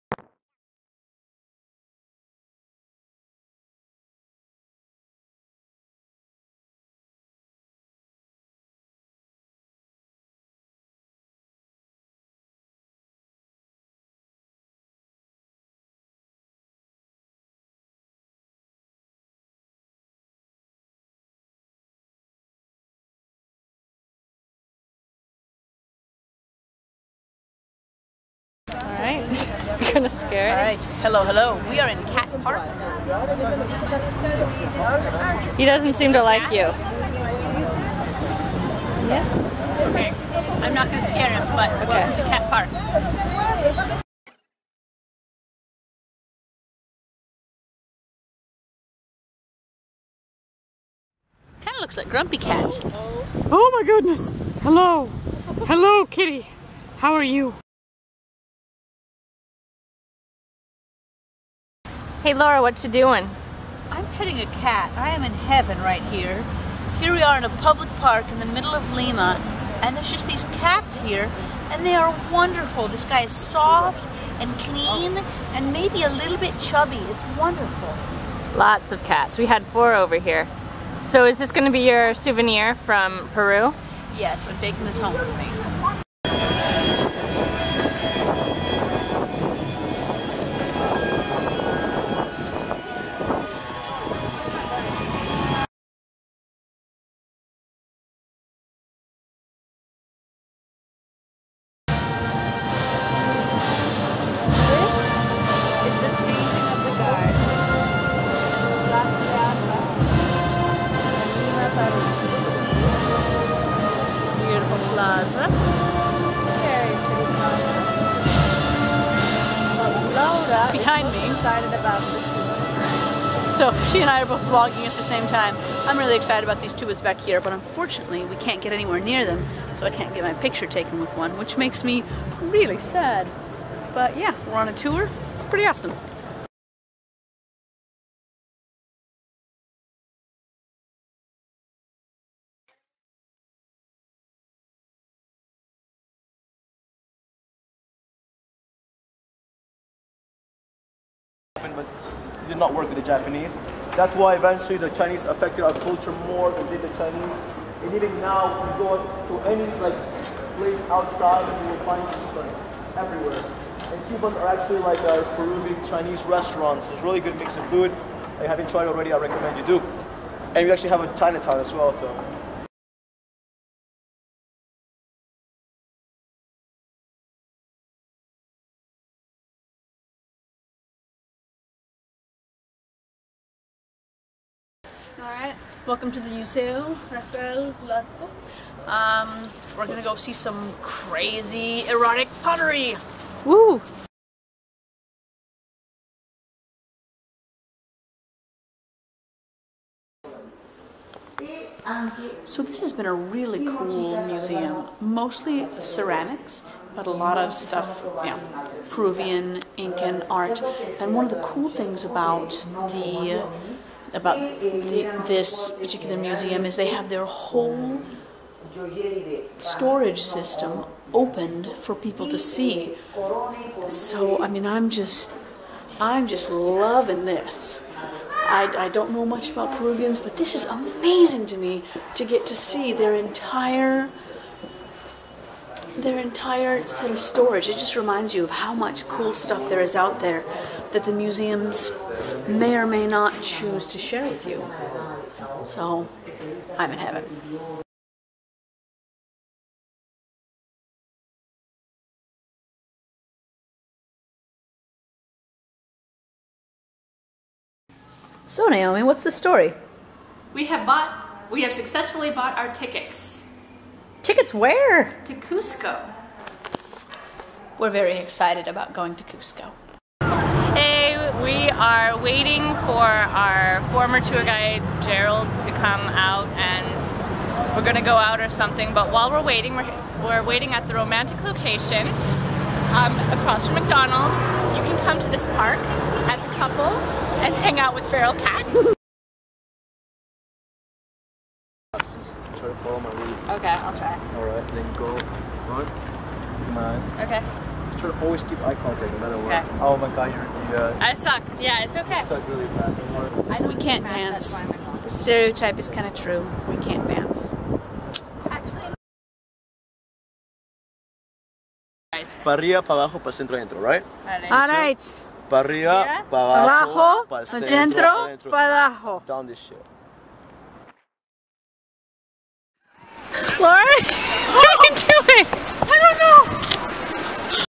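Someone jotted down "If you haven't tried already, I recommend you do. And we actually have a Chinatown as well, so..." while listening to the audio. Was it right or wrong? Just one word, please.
right.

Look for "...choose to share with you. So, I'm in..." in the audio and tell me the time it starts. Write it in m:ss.
4:03.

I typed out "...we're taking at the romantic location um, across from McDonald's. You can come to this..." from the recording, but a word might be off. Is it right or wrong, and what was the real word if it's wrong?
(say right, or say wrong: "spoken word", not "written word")
wrong: "waiting", not "taking".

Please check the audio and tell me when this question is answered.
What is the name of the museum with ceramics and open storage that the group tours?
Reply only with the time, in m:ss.
3:06.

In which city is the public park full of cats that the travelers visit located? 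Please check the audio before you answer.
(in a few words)
Lima.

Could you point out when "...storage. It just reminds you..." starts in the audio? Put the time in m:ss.
3:57.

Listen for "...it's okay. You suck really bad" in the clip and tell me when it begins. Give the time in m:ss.
5:01.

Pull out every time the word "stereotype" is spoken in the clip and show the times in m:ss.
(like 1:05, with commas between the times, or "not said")
5:05.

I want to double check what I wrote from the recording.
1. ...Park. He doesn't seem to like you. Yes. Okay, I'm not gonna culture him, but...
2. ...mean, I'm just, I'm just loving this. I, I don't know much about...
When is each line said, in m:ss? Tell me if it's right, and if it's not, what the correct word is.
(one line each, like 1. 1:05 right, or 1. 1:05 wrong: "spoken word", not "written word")
1. 0:32 wrong: "scare", not "culture"
2. 3:44 right.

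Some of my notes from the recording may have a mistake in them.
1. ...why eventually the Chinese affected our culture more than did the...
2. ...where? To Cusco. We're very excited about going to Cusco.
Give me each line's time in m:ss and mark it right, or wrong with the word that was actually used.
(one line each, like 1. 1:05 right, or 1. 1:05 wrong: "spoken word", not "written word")
1. 2:34 right
2. 4:24 right.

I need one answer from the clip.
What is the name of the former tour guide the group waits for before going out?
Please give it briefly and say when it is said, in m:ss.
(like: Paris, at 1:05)
Gerald, at 4:35.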